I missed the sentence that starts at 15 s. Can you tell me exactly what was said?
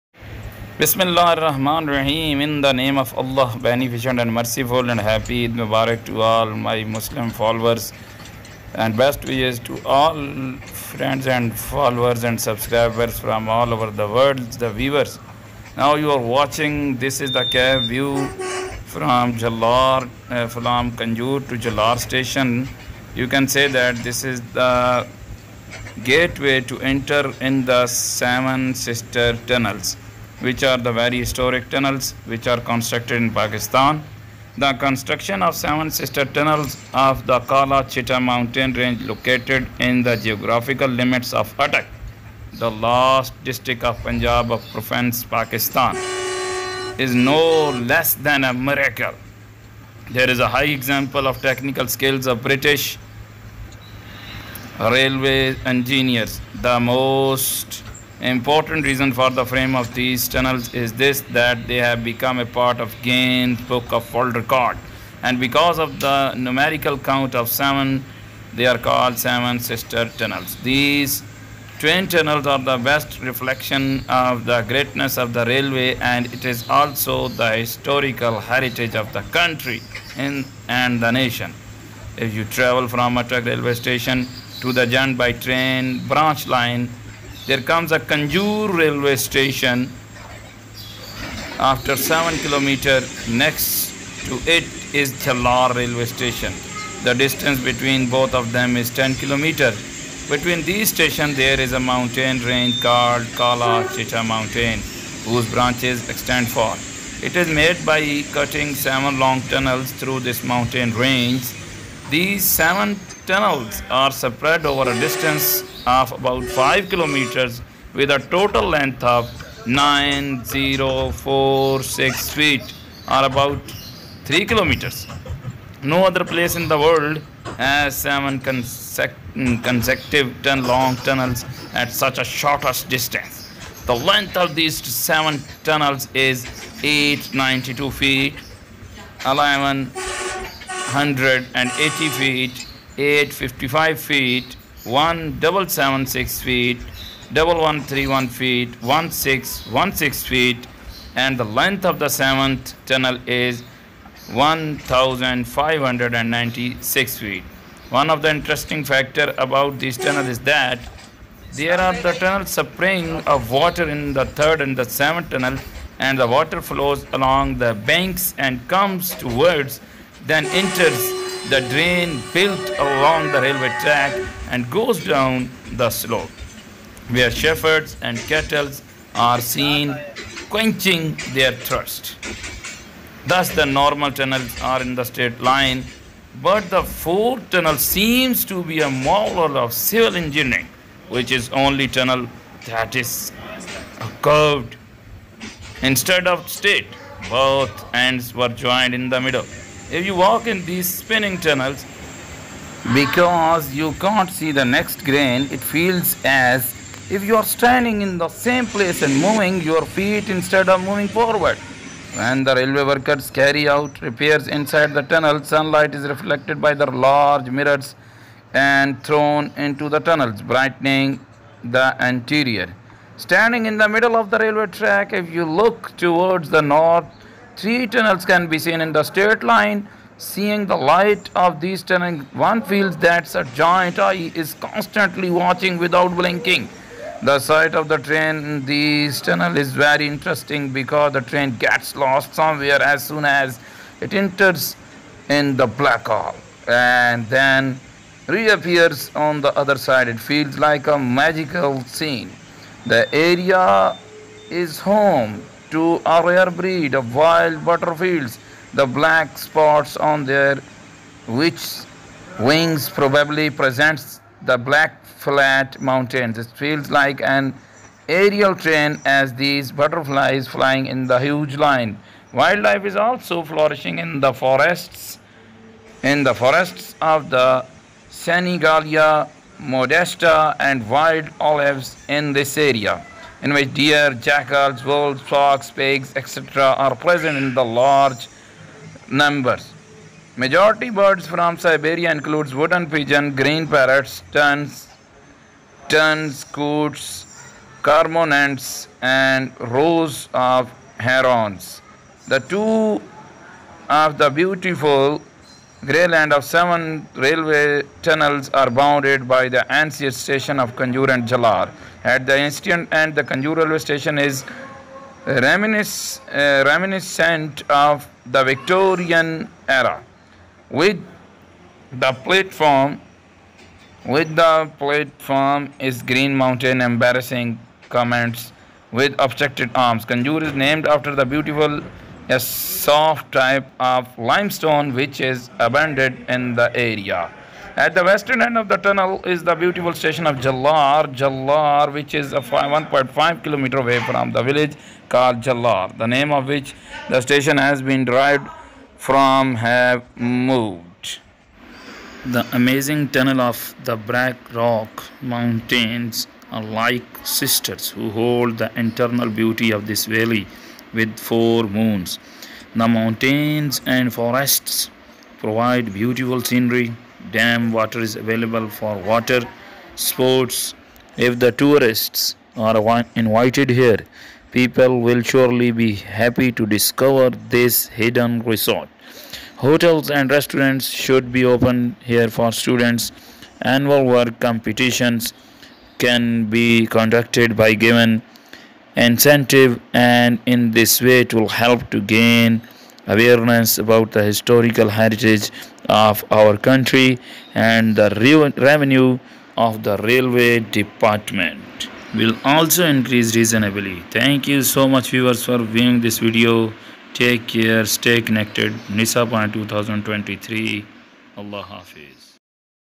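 Now you are watching, this is the cab view from Jalar, uh, from Kanjur to Jalar station.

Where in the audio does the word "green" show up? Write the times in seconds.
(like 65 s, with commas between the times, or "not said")
293 s, 326 s.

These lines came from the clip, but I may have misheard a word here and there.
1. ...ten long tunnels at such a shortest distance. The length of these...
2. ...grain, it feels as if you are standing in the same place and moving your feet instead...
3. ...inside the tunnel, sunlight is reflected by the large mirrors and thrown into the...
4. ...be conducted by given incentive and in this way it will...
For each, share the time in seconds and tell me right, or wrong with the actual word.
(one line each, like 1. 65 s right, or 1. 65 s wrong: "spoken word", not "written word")
1. 130 s right
2. 205 s right
3. 214 s right
4. 386 s right.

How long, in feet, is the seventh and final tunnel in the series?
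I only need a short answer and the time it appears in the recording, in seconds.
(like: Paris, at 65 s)
1596 feet, at 154 s.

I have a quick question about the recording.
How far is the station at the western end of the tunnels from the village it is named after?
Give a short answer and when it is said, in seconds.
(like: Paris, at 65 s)
1.5 kilometers, at 342 s.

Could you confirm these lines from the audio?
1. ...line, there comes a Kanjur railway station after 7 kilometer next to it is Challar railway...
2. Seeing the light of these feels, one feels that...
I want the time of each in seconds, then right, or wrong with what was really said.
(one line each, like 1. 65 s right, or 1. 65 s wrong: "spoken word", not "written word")
1. 86 s right
2. 230 s wrong: "tunnels", not "feels".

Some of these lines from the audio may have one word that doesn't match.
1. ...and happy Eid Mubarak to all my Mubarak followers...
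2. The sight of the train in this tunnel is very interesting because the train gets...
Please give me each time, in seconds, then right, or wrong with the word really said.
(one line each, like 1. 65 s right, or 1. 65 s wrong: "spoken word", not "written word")
1. 4 s wrong: "Muslim", not "Mubarak"
2. 237 s right.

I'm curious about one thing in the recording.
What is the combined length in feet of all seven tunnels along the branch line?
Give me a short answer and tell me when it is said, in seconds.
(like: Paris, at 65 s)
9046 feet, at 119 s.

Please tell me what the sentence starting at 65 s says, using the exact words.
And because of the numerical count of seven, they are called seven sister tunnels.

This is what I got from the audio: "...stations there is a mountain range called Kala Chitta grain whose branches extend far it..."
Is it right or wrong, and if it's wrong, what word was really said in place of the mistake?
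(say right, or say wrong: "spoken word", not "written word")
wrong: "mountain", not "grain".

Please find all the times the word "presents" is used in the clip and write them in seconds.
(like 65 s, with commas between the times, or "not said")
263 s, 286 s.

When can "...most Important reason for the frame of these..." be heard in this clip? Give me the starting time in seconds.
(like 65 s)
56 s.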